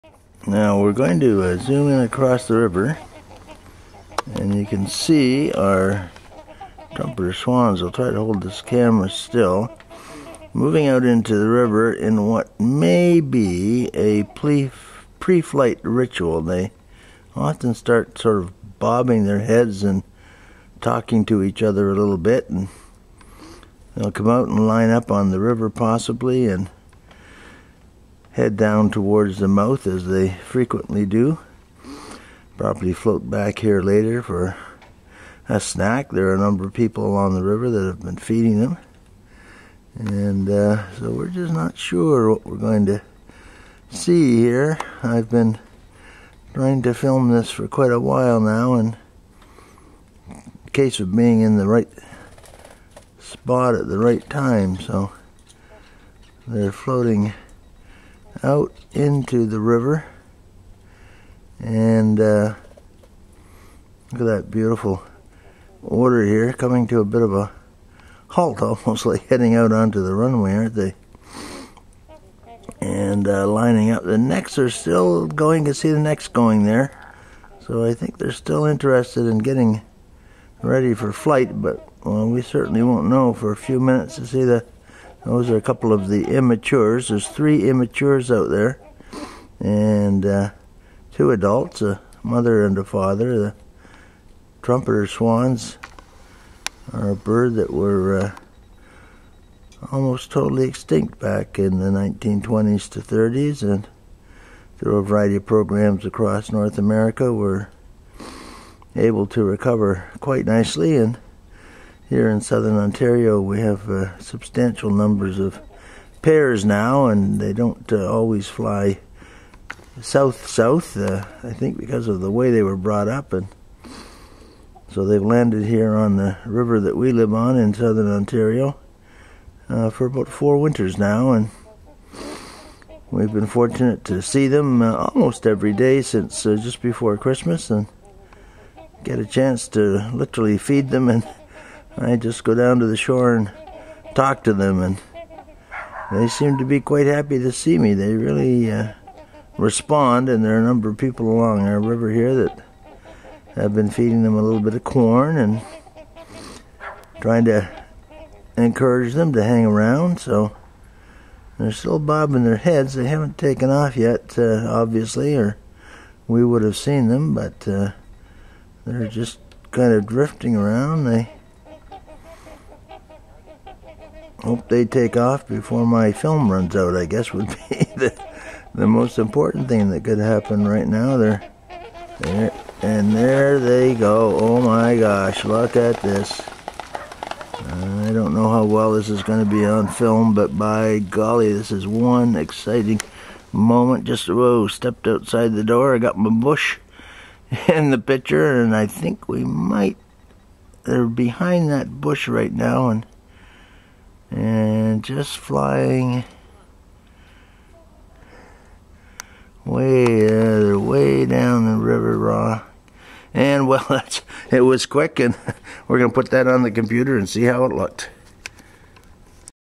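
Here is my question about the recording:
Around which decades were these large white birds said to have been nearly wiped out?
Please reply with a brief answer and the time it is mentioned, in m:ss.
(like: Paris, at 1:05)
1920s to 30s, at 1:41.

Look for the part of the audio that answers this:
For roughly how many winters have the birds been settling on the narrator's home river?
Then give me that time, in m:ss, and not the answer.
2:10.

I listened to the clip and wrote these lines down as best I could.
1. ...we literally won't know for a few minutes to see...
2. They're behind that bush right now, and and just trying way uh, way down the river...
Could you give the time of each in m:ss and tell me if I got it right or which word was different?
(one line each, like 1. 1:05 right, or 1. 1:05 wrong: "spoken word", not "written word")
1. 1:22 wrong: "certainly", not "literally"
2. 3:20 wrong: "flying", not "trying".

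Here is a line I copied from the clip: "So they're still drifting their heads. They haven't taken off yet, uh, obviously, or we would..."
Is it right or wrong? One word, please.
wrong.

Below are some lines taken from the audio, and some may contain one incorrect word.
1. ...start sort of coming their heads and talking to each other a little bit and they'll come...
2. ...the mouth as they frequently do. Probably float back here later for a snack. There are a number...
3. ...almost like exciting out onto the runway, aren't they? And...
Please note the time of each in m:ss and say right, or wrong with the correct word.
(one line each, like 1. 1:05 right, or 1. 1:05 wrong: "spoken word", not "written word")
1. 0:17 wrong: "bobbing", not "coming"
2. 0:29 right
3. 1:08 wrong: "heading", not "exciting".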